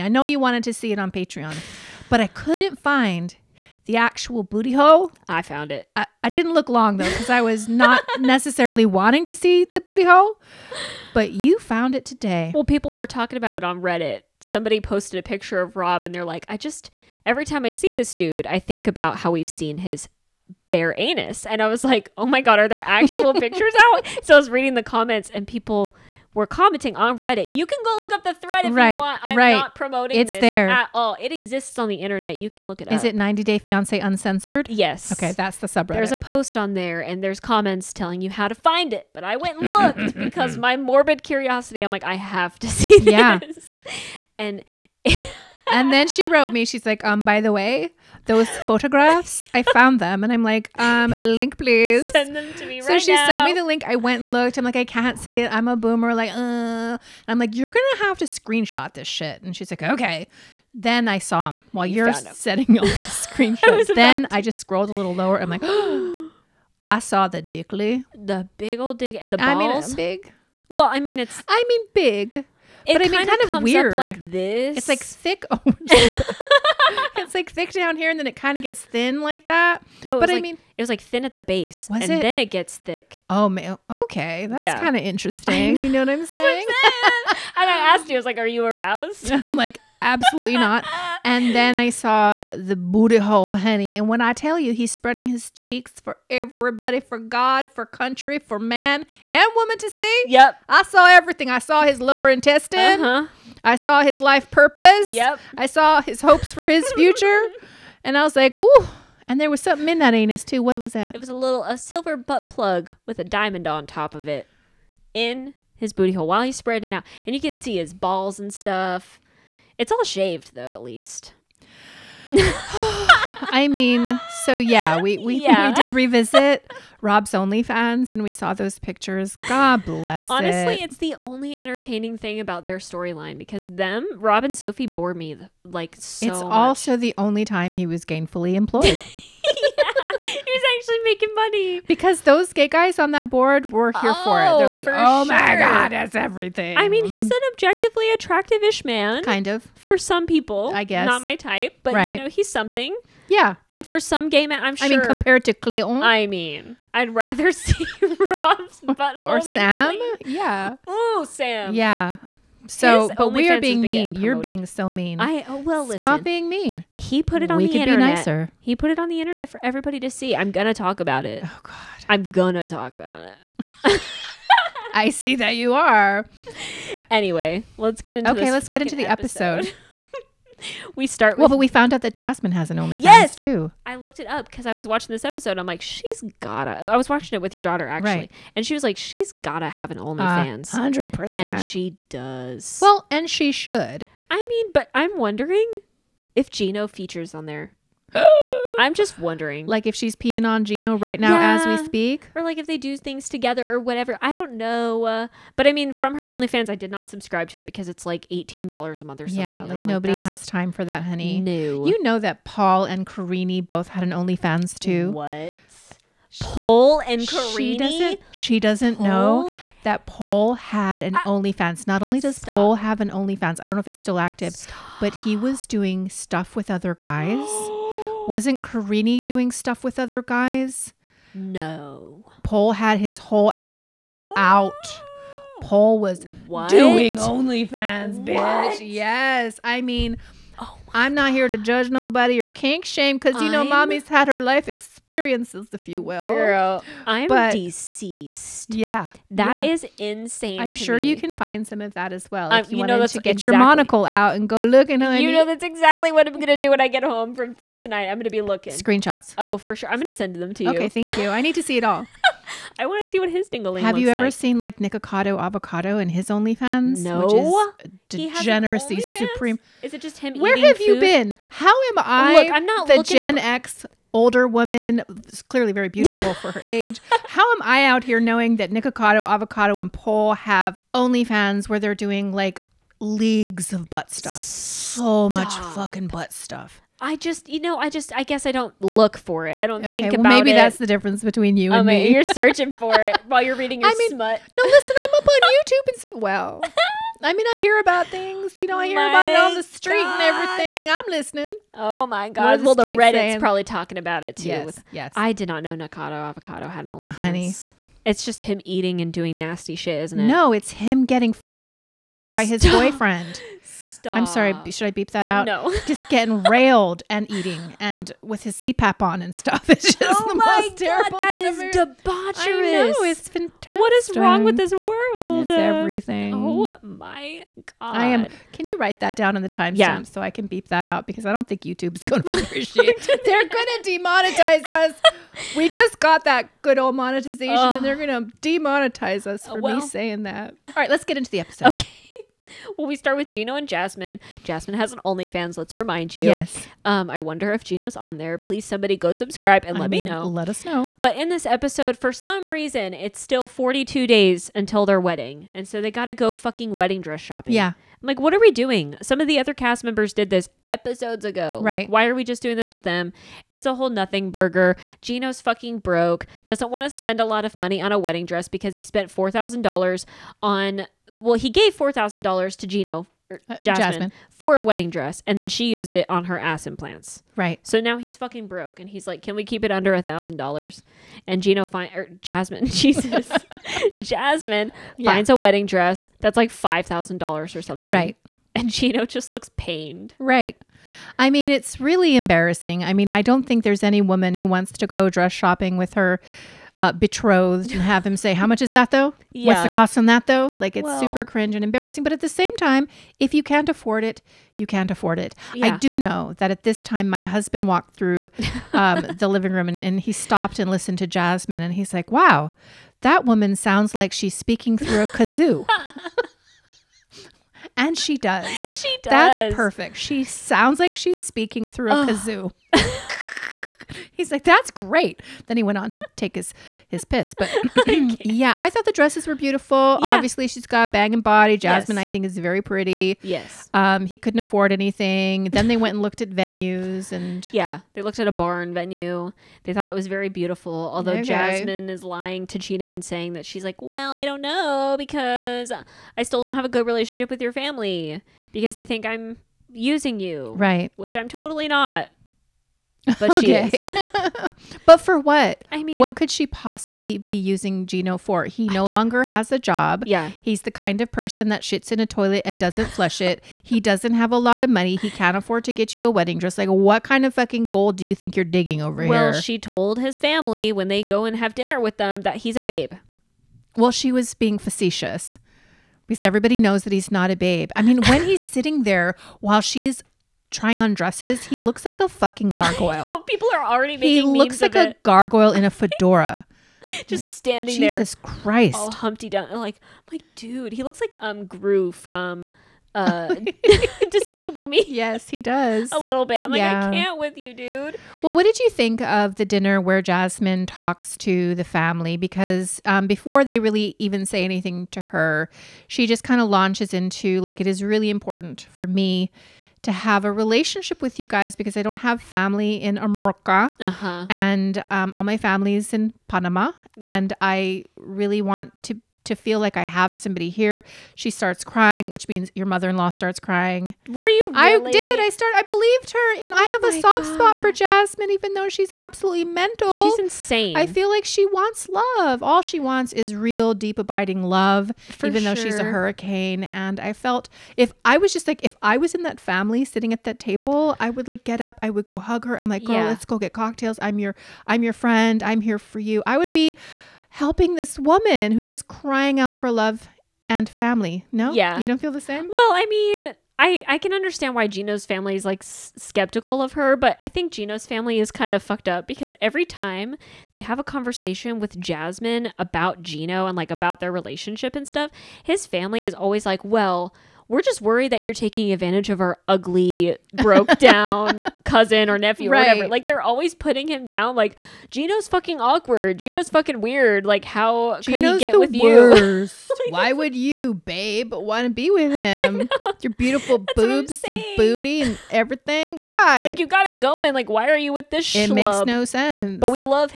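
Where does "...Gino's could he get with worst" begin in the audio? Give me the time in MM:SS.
09:38.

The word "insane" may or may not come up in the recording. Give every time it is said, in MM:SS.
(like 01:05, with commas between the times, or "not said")
04:09, 08:50.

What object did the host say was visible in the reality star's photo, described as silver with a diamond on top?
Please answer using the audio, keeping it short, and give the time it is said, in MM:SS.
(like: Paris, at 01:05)
butt plug, at 01:52.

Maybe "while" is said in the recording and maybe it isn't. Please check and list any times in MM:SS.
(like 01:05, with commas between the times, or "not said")
01:01, 01:56, 04:53, 07:59.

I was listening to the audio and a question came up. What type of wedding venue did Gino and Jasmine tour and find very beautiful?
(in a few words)
barn.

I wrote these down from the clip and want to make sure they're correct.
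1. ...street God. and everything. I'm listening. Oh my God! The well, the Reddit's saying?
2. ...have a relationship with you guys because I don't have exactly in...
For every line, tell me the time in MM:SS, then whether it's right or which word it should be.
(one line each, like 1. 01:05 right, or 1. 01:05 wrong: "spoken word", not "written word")
1. 04:59 right
2. 08:29 wrong: "family", not "exactly".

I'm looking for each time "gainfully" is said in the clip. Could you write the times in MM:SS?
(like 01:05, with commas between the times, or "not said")
02:18.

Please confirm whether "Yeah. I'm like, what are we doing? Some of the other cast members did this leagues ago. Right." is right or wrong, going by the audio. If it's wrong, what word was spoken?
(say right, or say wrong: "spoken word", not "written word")
wrong: "episodes", not "leagues".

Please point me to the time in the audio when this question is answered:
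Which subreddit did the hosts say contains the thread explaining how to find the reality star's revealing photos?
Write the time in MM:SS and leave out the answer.
00:33.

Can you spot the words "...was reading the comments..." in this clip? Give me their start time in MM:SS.
00:24.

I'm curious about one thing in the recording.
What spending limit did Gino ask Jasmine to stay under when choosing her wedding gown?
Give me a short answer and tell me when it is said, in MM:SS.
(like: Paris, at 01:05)
$1,000, at 06:19.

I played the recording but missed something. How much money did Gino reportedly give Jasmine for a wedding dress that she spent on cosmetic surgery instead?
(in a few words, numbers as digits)
$4,000.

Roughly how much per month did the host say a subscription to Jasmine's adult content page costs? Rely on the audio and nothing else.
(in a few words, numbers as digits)
$18.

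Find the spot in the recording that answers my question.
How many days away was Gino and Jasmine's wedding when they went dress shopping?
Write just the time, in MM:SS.
05:53.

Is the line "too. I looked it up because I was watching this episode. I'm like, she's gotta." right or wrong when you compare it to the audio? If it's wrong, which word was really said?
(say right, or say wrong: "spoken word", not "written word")
right.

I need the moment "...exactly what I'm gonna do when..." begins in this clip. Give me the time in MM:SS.
04:15.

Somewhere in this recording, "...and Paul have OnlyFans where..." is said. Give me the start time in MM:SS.
04:39.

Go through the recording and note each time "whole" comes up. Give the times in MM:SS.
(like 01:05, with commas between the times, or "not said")
03:53, 06:03.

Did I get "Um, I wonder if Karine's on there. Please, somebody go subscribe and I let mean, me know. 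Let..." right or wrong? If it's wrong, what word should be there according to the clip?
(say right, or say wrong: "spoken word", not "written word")
wrong: "Gino", not "Karine".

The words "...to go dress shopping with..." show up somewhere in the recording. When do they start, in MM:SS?
06:34.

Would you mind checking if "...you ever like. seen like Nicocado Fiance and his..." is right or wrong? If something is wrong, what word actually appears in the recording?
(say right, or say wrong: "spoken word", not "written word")
wrong: "Avocado", not "Fiance".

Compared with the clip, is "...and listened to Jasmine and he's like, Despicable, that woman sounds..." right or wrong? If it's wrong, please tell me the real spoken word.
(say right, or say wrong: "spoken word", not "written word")
wrong: "Wow", not "Despicable".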